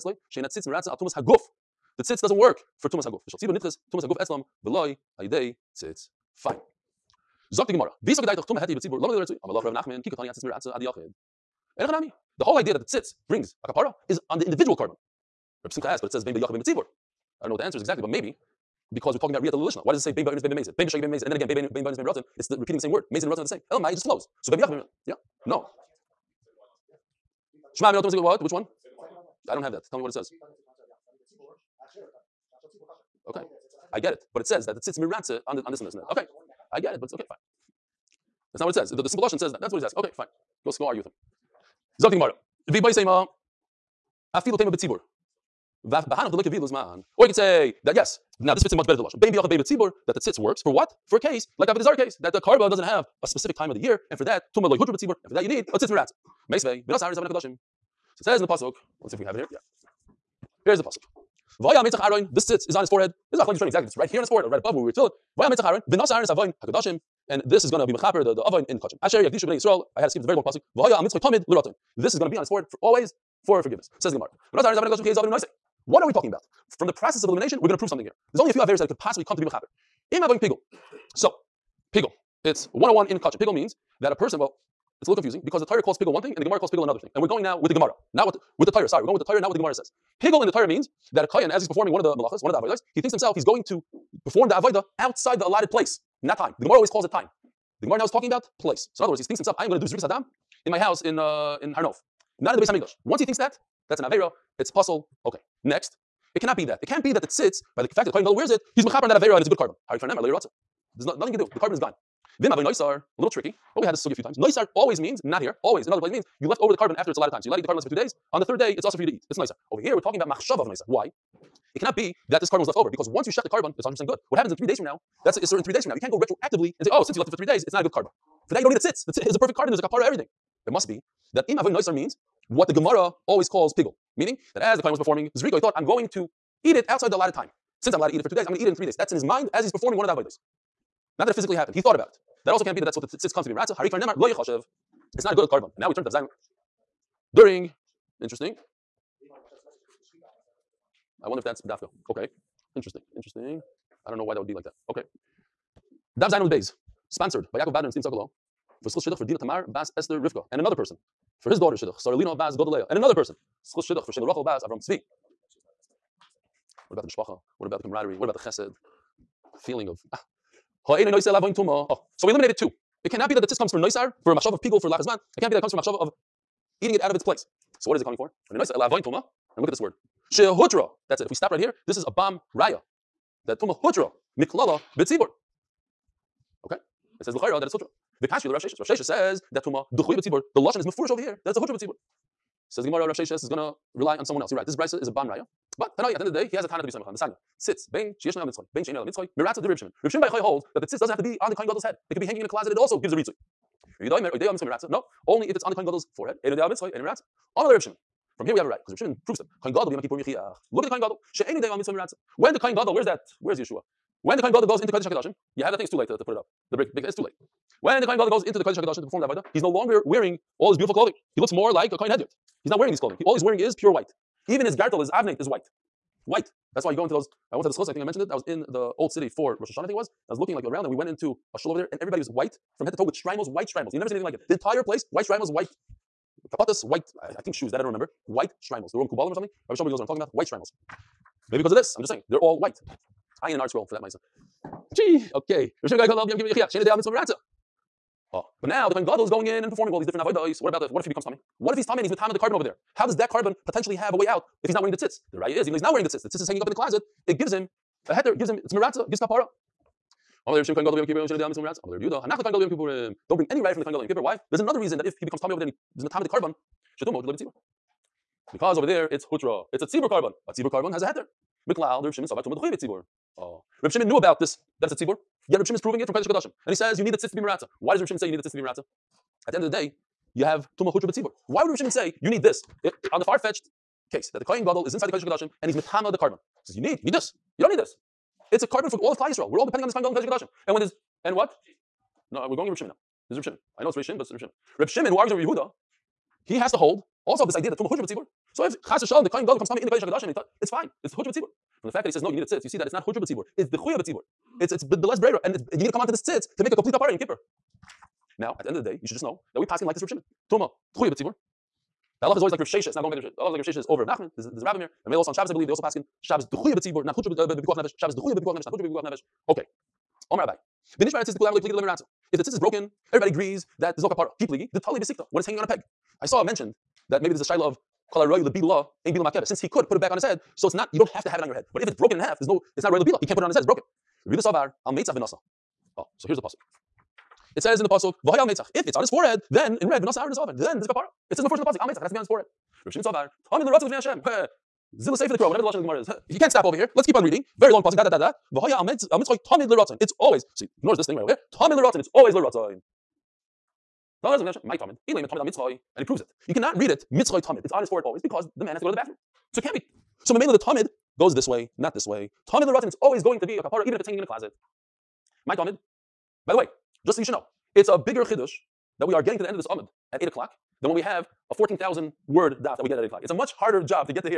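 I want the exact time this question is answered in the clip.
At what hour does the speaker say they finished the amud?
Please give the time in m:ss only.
6:10.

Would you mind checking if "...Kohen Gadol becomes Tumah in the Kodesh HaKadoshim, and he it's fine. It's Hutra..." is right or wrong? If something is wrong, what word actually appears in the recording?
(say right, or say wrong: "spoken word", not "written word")
right.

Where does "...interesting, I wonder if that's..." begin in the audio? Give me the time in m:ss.
2:28.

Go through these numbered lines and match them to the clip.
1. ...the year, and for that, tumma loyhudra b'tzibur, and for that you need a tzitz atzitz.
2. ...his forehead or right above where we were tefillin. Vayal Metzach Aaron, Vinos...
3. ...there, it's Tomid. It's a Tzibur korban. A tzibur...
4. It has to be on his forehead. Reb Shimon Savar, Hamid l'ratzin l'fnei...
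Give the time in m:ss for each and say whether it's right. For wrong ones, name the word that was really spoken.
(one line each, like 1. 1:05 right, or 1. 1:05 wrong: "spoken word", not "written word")
1. 0:53 wrong: "miratz", not "atzitz"
2. 1:04 right
3. 4:28 wrong: "Hutra", not "Tomid"
4. 5:42 right.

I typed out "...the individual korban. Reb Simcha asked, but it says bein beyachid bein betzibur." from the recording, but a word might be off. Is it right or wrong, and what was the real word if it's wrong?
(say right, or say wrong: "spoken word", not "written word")
right.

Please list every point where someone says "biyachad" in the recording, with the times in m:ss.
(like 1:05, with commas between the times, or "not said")
0:49.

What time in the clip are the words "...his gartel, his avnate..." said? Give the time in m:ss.
3:44.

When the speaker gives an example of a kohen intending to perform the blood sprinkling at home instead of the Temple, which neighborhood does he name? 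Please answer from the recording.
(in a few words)
Har Nof.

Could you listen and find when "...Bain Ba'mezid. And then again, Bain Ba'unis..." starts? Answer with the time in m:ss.
0:21.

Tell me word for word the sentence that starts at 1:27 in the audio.
And we're going now with the Gemara, not what the, with the Torah.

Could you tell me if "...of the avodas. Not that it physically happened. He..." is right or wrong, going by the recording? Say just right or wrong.
right.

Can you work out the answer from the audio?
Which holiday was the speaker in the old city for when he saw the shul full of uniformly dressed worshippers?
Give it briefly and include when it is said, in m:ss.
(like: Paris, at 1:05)
Rosh Hashanah, at 3:49.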